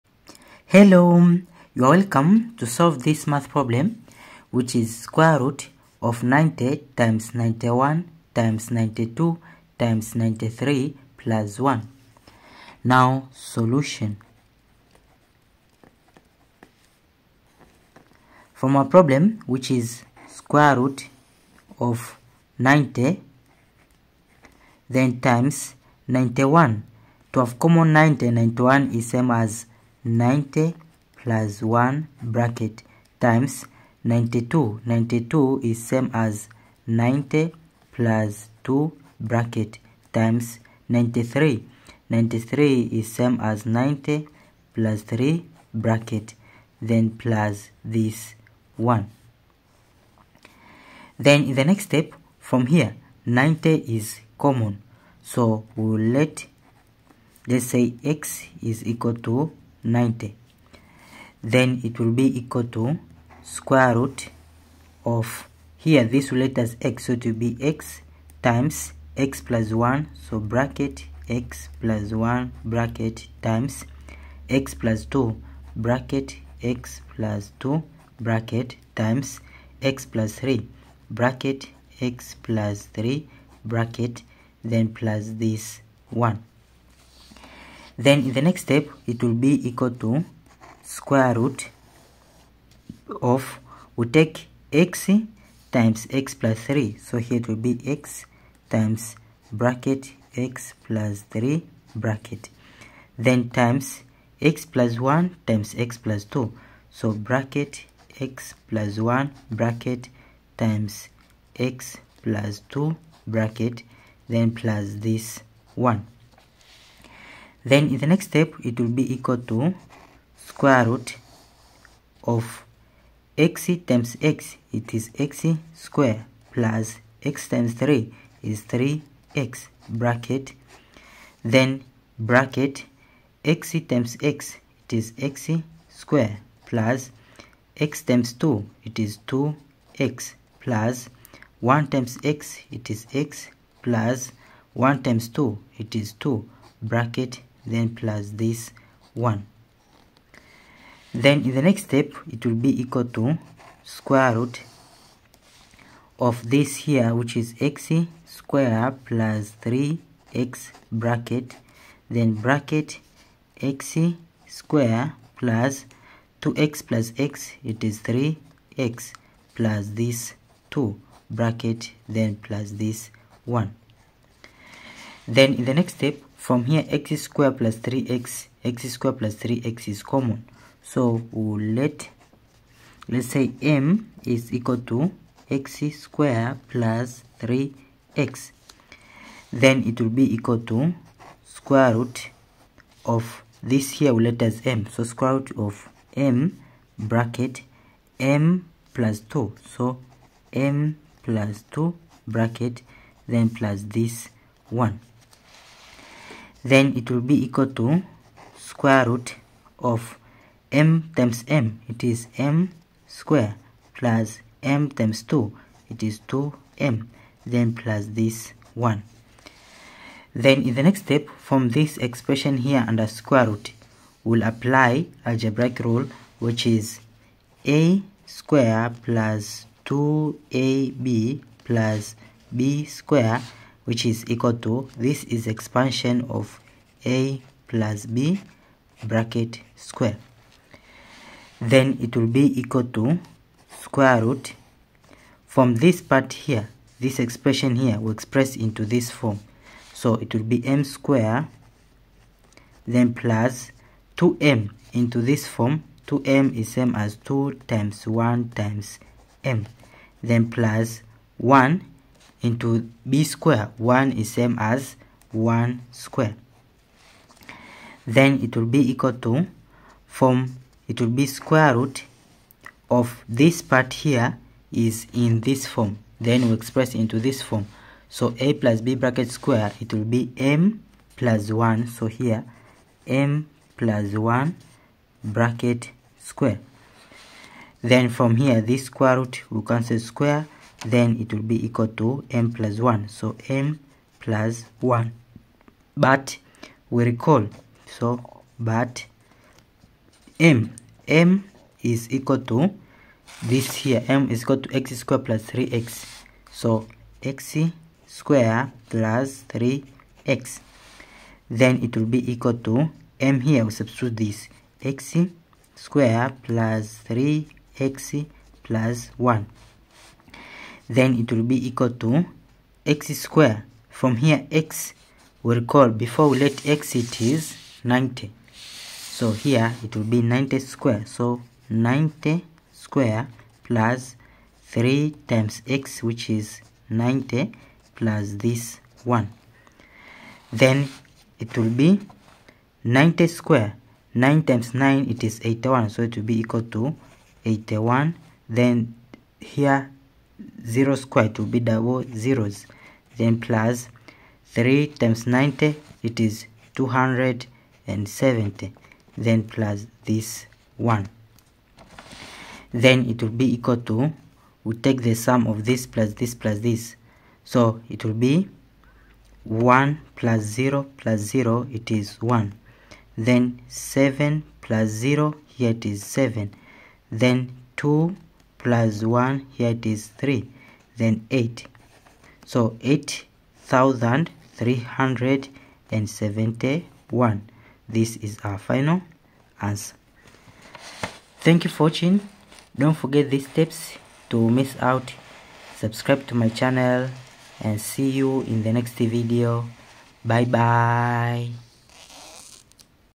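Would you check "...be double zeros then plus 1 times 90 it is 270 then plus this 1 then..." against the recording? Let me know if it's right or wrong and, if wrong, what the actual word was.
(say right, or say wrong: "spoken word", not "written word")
wrong: "3", not "1".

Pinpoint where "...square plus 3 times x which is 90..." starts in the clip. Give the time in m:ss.
5:32.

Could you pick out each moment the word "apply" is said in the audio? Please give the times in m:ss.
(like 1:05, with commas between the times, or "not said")
3:44.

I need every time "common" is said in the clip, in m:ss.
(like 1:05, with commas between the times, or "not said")
0:27, 0:54, 3:00.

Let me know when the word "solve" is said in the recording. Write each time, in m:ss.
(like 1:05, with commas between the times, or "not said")
0:02.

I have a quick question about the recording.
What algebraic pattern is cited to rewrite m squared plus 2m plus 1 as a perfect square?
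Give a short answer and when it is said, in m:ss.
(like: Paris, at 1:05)
a square plus 2ab plus b square, at 3:47.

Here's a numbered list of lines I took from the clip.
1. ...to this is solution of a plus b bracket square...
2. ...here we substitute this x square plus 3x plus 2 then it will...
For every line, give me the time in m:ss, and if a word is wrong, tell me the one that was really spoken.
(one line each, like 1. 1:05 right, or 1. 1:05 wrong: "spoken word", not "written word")
1. 3:54 wrong: "expansion", not "solution"
2. 5:13 wrong: "1", not "2".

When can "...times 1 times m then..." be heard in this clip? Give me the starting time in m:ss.
4:17.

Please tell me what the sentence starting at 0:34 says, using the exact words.
92 is same as 90 plus 2 bracket times 93.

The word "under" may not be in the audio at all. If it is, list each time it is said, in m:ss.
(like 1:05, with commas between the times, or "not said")
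3:42.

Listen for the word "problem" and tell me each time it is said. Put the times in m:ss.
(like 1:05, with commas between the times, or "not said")
0:03, 0:18.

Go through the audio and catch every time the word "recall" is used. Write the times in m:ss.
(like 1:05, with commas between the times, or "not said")
4:57, 5:25.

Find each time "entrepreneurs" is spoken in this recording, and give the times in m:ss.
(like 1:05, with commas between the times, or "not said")
not said.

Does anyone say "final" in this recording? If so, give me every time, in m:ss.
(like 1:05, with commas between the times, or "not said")
6:28.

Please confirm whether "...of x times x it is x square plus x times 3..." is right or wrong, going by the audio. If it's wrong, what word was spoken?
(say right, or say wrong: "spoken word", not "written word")
right.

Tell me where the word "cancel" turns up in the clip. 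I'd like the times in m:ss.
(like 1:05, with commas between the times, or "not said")
4:49.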